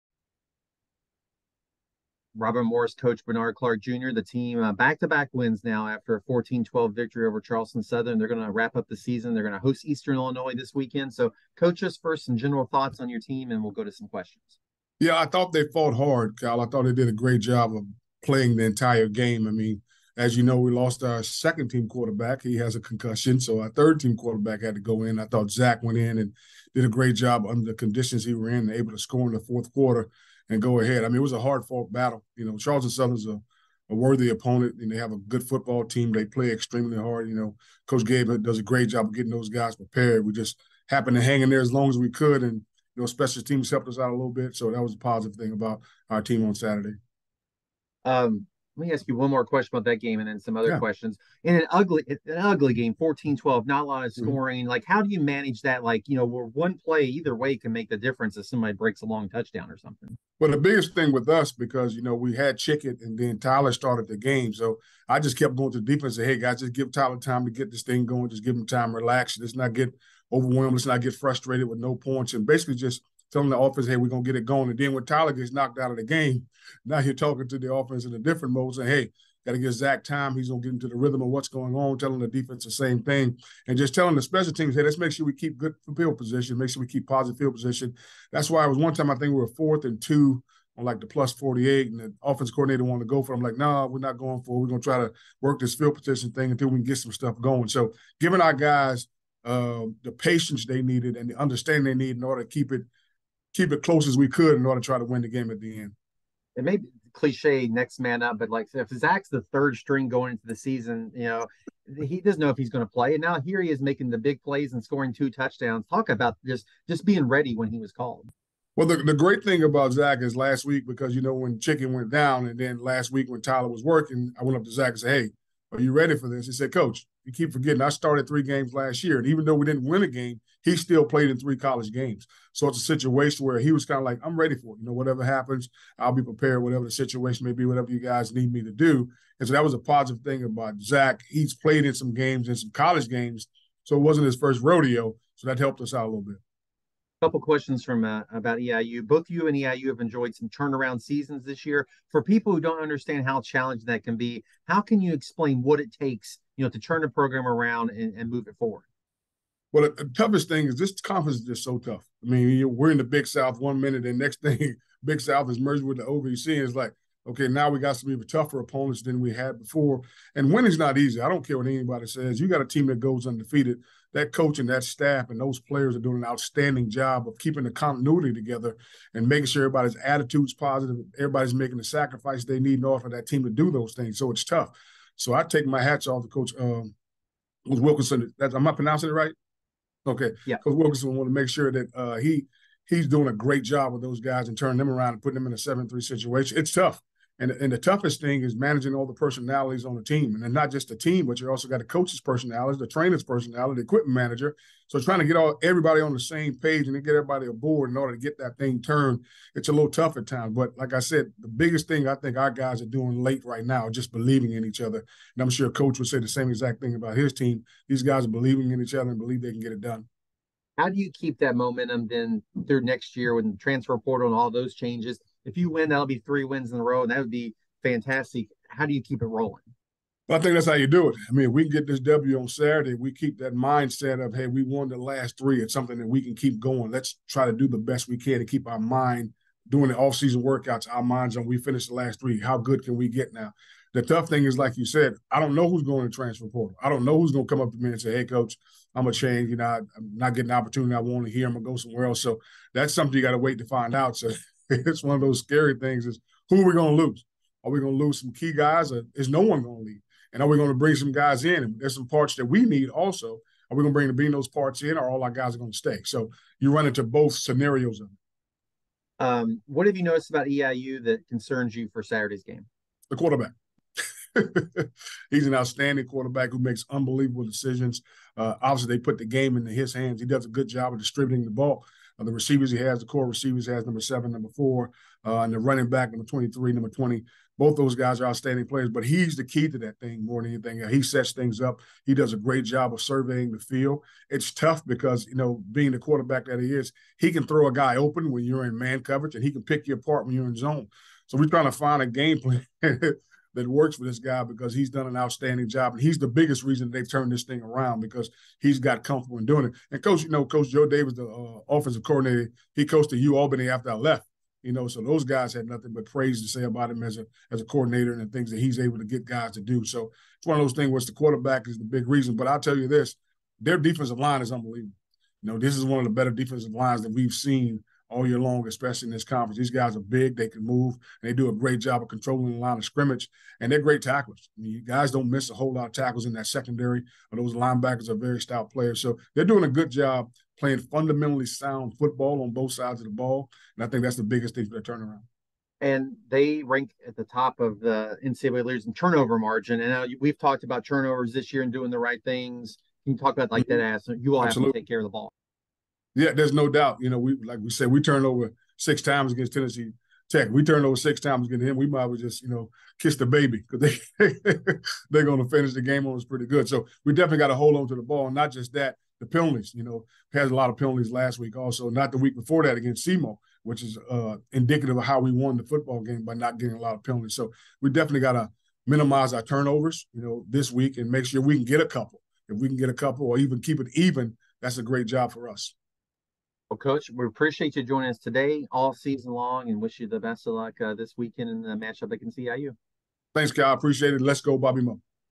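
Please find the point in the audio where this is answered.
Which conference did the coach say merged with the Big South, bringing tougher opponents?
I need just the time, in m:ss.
2:46.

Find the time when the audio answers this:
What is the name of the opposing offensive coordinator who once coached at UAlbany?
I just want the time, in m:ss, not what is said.
5:10.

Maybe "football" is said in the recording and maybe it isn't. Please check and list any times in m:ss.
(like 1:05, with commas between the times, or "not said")
0:35, 5:41, 6:15.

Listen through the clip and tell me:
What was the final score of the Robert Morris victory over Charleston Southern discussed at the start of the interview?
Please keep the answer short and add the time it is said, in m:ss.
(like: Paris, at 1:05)
14-12, at 0:06.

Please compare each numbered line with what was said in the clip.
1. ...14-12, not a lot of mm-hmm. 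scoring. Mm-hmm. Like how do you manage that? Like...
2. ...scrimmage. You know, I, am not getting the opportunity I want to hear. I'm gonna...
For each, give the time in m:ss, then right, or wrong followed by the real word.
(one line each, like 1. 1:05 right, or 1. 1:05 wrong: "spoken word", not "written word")
1. 0:52 right
2. 4:09 wrong: "change", not "scrimmage".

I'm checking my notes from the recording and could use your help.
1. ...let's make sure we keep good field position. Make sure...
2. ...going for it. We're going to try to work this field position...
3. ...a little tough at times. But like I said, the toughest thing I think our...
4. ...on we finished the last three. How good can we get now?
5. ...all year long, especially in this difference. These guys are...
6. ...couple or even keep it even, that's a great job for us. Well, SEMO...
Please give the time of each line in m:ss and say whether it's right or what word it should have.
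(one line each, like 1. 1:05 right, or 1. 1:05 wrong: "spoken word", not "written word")
1. 1:24 right
2. 1:34 right
3. 3:29 wrong: "biggest", not "toughest"
4. 4:01 right
5. 5:28 wrong: "conference", not "difference"
6. 6:22 wrong: "Coach", not "SEMO".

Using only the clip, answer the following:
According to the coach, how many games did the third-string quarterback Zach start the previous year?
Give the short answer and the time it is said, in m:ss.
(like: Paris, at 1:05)
3, at 2:08.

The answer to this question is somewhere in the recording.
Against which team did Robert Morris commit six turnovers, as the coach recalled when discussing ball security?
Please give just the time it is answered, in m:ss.
5:59.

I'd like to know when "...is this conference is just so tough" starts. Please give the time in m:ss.
2:40.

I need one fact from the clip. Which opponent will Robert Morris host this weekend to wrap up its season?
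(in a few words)
Eastern Illinois.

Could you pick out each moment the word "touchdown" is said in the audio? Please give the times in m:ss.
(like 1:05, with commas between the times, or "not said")
0:59, 1:55.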